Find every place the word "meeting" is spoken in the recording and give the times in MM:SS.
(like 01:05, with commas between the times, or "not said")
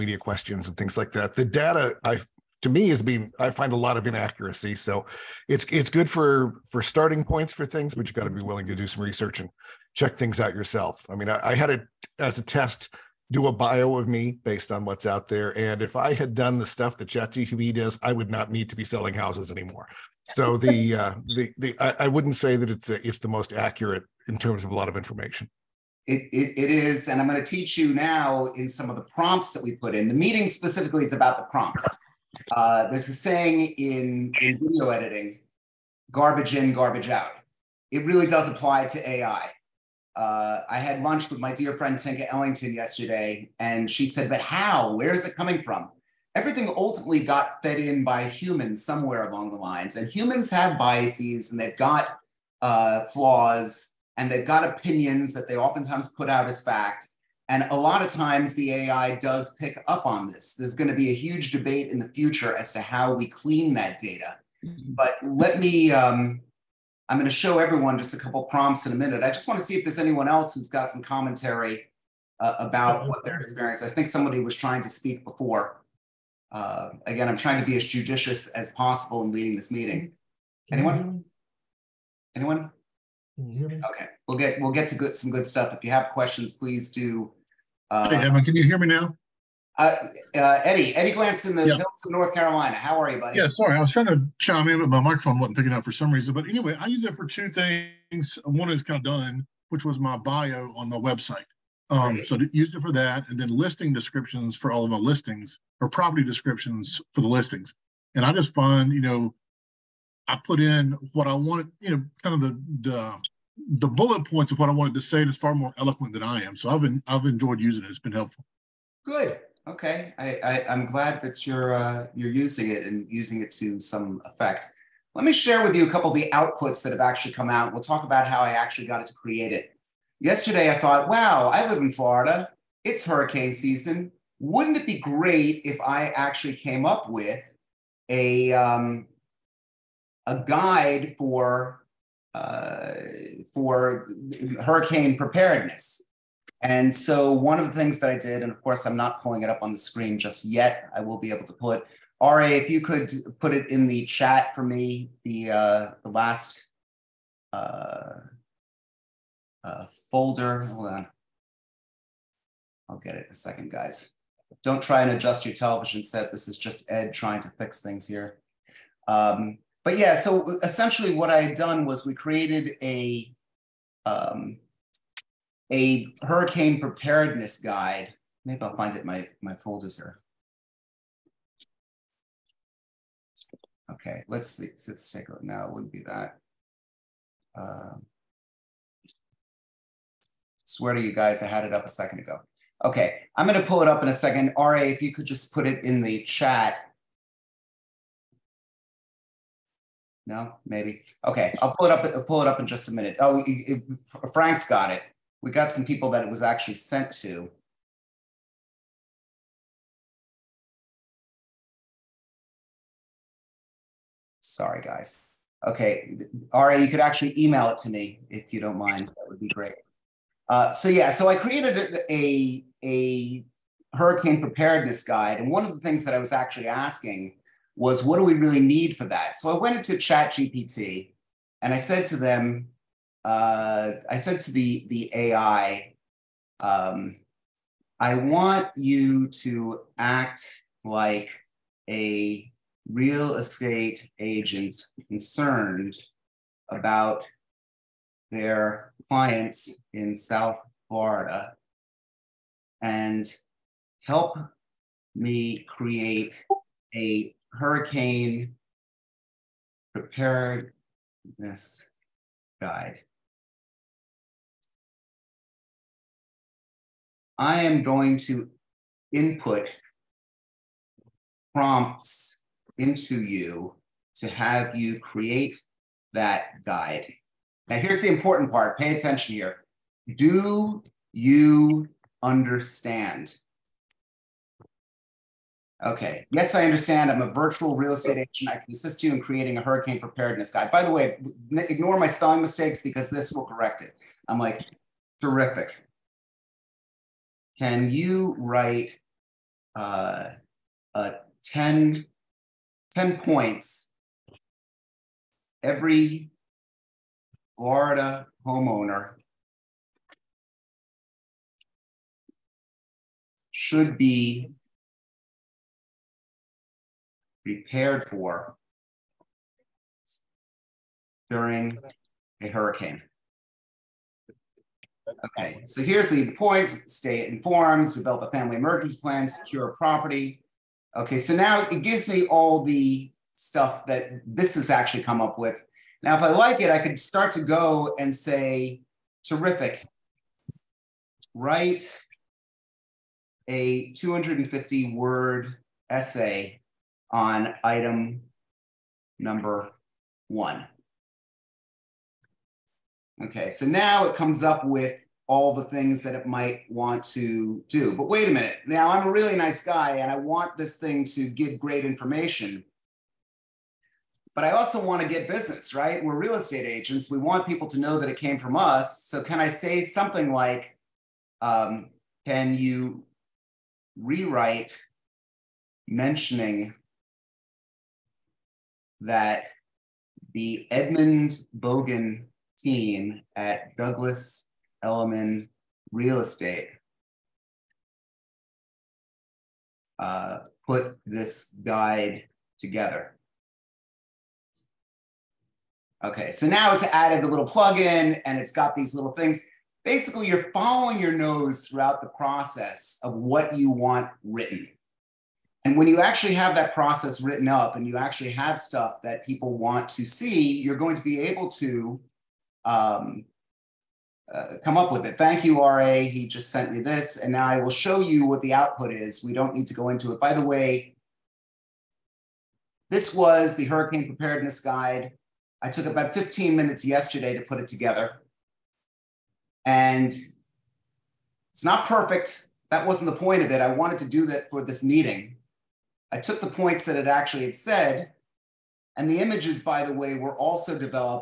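00:30, 01:19, 07:14.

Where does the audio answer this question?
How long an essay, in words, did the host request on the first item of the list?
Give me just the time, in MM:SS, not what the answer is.
05:43.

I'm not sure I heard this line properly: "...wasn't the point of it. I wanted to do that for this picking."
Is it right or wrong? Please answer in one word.
wrong.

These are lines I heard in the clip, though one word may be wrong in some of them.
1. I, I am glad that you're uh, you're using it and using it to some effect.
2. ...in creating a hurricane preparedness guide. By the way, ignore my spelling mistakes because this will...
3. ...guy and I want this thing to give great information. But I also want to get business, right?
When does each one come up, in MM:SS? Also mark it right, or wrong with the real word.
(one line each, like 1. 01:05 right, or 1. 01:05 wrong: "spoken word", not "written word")
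1. 02:00 right
2. 04:49 right
3. 05:59 right.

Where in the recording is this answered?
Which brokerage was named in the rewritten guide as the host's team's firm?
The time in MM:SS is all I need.
06:23.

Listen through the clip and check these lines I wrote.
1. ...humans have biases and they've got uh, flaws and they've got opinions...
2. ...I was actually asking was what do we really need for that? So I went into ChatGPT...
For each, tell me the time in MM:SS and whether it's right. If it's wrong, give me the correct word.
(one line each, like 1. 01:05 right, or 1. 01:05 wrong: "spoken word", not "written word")
1. 00:50 right
2. 03:46 right.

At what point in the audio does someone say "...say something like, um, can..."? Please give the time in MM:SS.
06:09.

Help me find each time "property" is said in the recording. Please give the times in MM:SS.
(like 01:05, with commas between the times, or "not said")
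01:45, 05:29.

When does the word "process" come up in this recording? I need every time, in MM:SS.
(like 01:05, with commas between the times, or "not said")
06:42, 06:46.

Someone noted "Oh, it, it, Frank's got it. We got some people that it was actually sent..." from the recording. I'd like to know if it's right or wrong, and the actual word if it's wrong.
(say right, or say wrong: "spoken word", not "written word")
right.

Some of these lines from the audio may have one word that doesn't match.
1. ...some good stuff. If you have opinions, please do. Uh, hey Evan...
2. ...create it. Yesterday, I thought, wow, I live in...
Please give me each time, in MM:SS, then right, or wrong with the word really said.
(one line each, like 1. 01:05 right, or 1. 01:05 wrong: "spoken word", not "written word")
1. 01:25 wrong: "questions", not "opinions"
2. 02:09 right.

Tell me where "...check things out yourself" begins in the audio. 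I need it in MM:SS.
00:09.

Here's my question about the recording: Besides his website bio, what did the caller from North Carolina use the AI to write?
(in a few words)
Listing descriptions.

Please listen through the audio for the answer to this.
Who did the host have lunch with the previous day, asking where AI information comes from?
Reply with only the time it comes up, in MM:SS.
00:41.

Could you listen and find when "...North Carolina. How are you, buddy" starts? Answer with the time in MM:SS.
01:32.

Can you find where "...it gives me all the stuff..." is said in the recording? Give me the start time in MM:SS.
05:31.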